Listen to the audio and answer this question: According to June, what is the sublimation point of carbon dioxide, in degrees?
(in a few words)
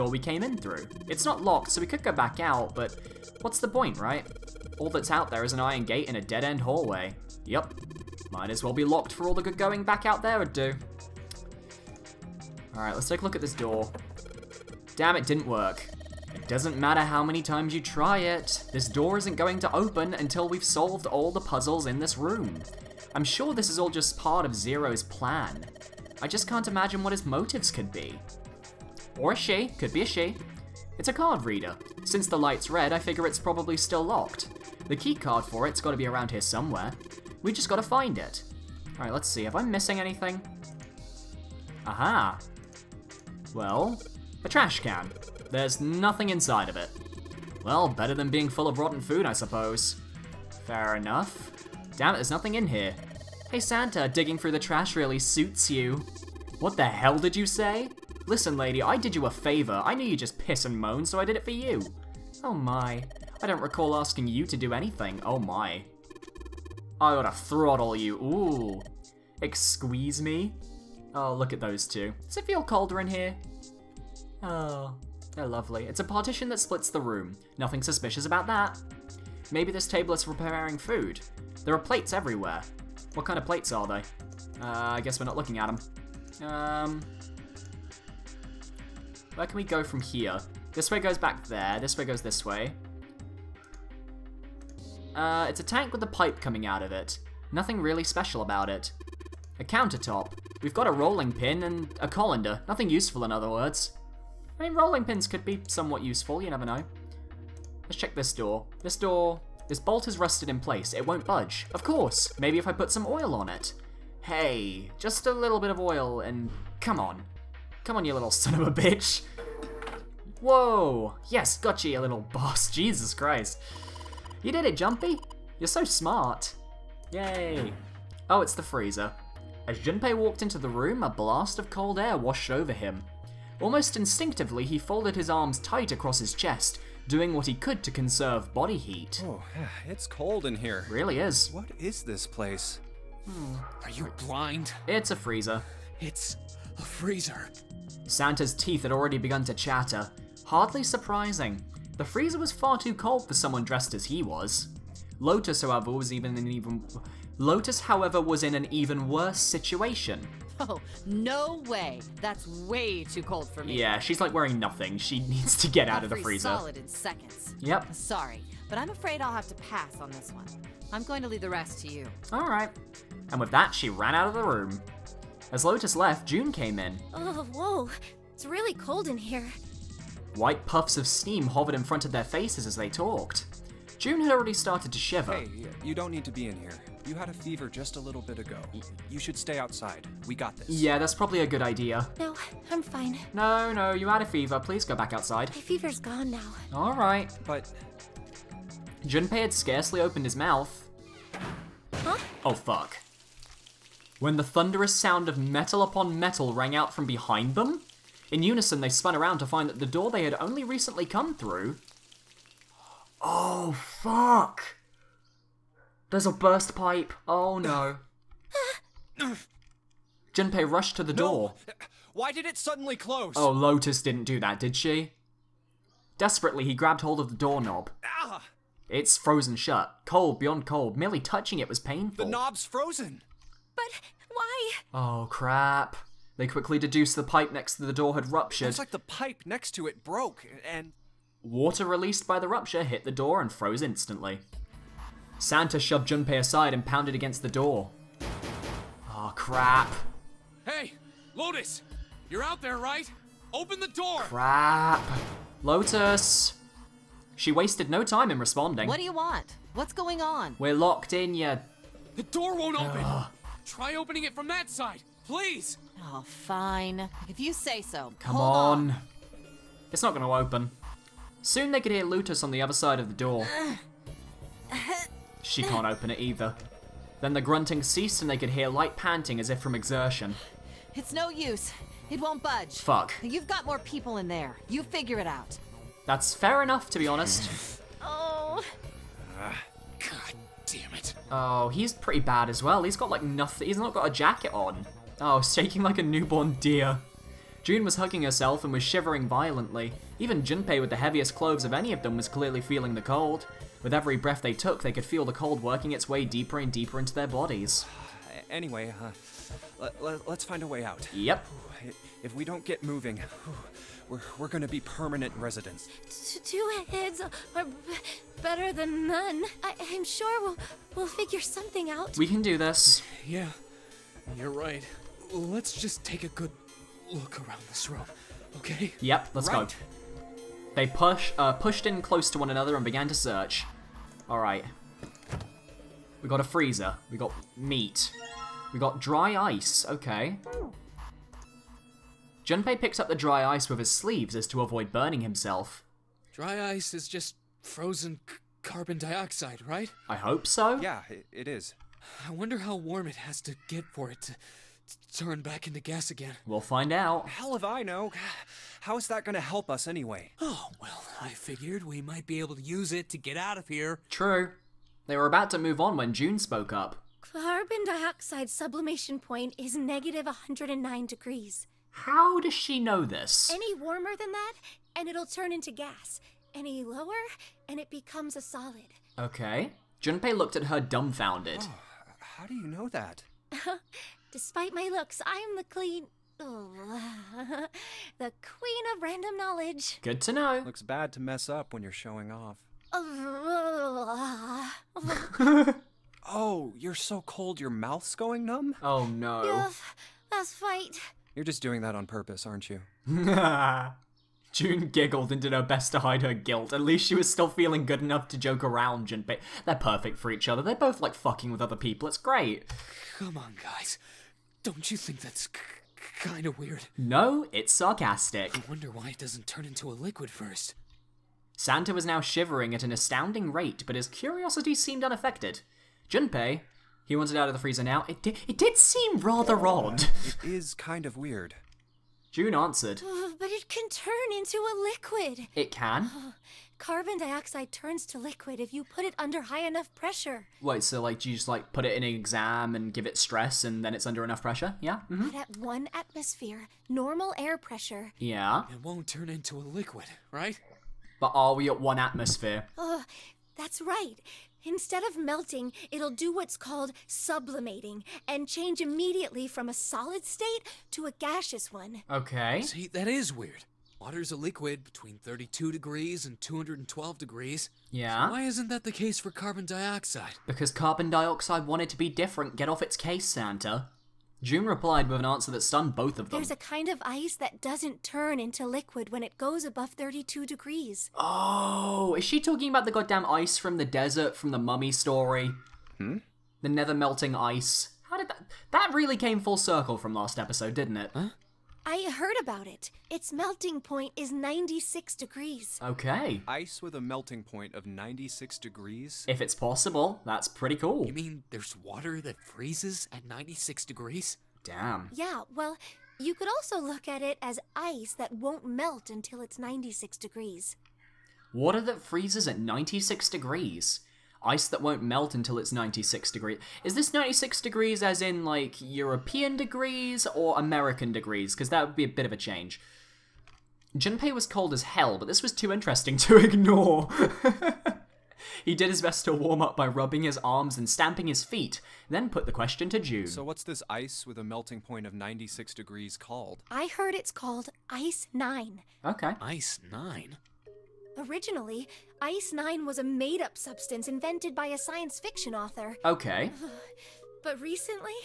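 -109.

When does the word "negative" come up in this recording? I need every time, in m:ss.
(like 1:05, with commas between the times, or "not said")
6:09.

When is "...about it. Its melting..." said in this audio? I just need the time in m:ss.
8:12.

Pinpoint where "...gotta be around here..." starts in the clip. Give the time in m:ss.
0:35.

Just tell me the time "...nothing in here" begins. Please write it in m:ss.
0:52.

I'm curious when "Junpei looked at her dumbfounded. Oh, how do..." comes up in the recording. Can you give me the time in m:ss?
6:20.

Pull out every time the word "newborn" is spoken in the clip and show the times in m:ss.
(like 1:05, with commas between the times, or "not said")
4:56.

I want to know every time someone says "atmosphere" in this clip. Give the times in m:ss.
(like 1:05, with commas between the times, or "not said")
7:25, 7:32.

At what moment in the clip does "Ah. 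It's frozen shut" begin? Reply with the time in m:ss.
3:48.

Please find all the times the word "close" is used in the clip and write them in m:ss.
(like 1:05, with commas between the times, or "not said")
3:42, 5:32.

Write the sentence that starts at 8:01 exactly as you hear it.
Oh, is she talking about the goddamn ice from the desert from the mummy story?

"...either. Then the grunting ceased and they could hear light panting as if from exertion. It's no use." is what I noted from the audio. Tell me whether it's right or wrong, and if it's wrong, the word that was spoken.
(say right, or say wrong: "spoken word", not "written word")
right.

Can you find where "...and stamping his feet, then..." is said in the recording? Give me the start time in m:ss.
8:50.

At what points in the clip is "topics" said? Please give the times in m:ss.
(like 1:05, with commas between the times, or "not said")
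not said.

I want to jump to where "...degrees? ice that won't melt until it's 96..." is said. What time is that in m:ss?
8:33.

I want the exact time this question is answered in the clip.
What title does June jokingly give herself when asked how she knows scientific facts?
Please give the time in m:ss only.
6:26.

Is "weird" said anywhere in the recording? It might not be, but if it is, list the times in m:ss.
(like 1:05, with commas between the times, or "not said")
6:56, 7:11, 7:43.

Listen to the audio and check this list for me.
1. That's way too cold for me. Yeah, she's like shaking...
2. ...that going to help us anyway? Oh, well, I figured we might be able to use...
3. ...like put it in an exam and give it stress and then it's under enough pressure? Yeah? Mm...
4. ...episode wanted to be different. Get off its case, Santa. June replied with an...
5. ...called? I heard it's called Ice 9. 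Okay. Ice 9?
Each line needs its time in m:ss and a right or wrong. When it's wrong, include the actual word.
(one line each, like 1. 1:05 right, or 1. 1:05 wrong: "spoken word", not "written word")
1. 2:42 wrong: "wearing", not "shaking"
2. 5:59 right
3. 7:21 right
4. 7:51 wrong: "dioxide", not "episode"
5. 8:56 right.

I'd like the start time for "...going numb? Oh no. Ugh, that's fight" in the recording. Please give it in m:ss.
6:38.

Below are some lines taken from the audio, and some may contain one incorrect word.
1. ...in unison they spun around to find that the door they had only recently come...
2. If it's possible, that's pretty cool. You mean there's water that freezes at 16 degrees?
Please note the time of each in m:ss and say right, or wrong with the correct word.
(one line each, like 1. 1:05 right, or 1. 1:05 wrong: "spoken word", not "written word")
1. 3:28 right
2. 8:19 wrong: "96", not "16".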